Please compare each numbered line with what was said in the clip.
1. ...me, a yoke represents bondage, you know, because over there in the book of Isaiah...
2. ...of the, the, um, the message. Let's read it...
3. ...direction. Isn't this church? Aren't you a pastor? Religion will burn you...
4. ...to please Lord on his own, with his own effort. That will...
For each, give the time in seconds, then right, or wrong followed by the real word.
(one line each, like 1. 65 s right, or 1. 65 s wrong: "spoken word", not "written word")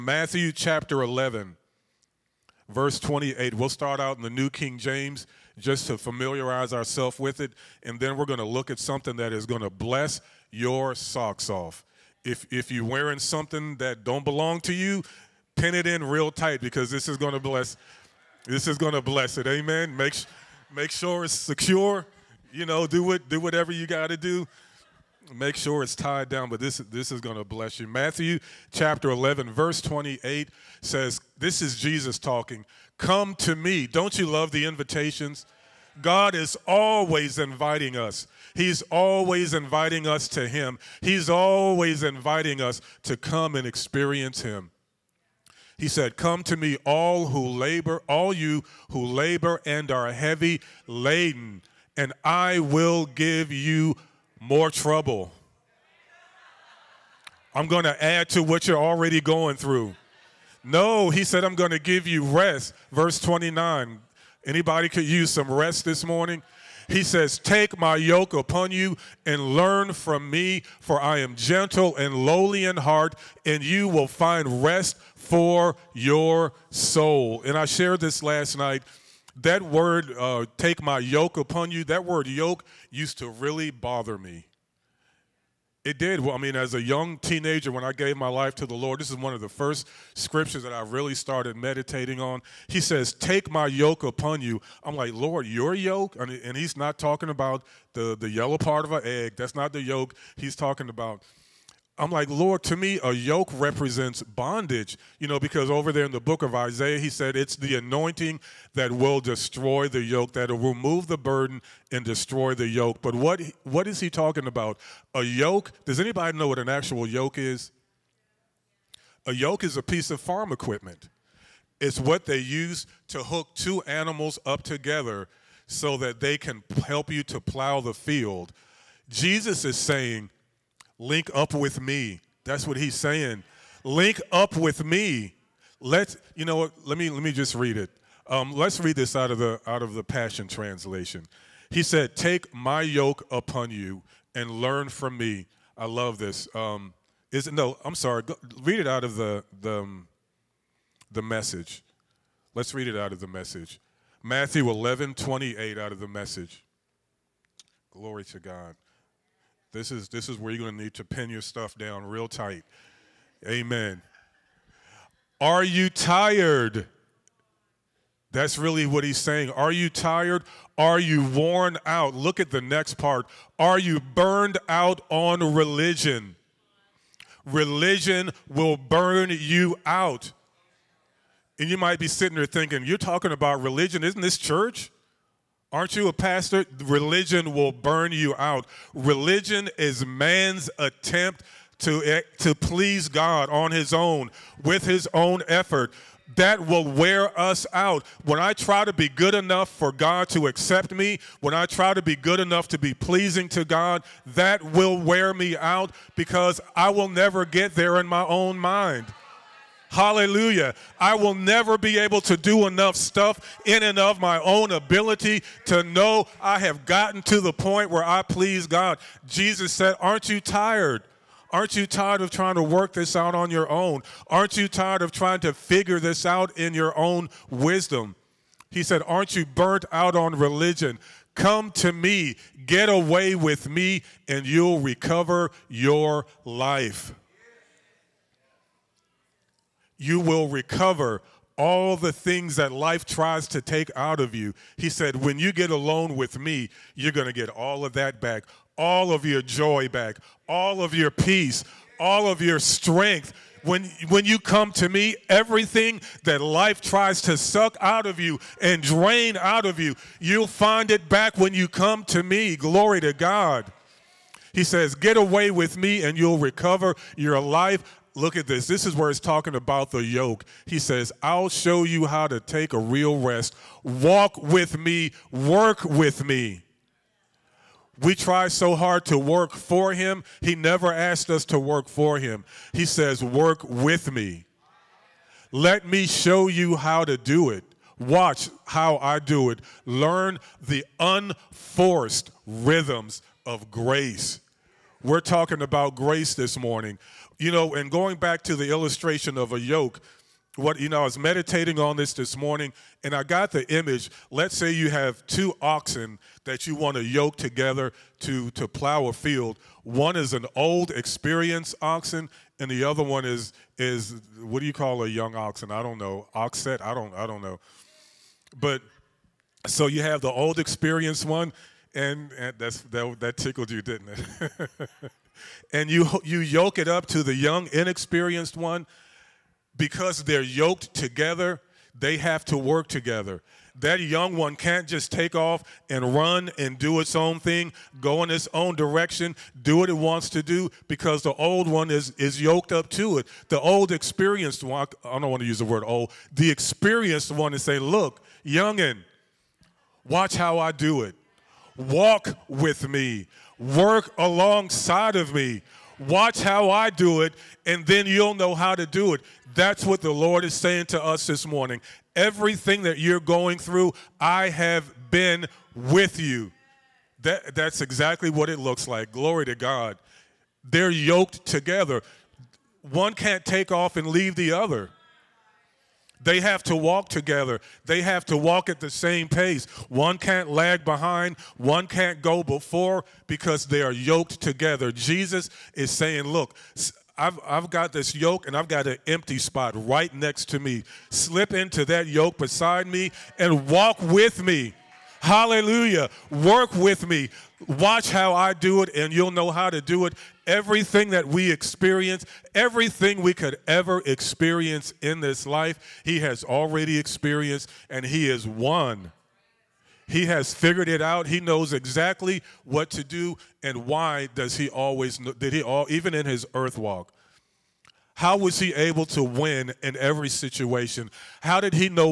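1. 102 s right
2. 149 s right
3. 183 s wrong: "religion", not "direction"
4. 192 s wrong: "God", not "Lord".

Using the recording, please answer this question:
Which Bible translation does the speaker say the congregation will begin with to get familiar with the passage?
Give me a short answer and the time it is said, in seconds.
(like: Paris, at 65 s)
New King James, at 4 s.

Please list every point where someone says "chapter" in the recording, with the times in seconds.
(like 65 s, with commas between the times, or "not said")
0 s, 28 s.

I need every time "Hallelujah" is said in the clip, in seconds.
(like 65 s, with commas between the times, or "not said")
209 s, 395 s.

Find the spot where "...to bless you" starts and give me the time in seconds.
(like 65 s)
27 s.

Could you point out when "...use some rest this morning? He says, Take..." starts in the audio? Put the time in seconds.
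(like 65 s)
65 s.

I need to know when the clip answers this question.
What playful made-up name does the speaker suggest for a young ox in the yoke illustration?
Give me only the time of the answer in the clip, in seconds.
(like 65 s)
316 s.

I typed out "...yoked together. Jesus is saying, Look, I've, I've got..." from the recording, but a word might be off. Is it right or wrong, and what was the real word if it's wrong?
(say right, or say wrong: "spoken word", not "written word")
right.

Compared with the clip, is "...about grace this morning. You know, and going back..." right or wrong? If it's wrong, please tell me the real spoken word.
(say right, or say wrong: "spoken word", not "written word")
right.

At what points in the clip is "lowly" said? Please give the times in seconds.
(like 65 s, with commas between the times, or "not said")
72 s.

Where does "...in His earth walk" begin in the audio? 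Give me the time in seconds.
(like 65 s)
416 s.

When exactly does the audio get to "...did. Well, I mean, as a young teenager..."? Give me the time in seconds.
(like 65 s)
85 s.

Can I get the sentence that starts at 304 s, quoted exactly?
Let's say you have two oxen that you want to yoke together to to plow a field.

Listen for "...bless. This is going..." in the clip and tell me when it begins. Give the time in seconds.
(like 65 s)
17 s.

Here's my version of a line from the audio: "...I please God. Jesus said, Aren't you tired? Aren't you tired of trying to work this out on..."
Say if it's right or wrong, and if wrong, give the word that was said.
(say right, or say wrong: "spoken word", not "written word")
right.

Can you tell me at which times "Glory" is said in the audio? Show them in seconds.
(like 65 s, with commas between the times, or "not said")
157 s, 262 s, 369 s.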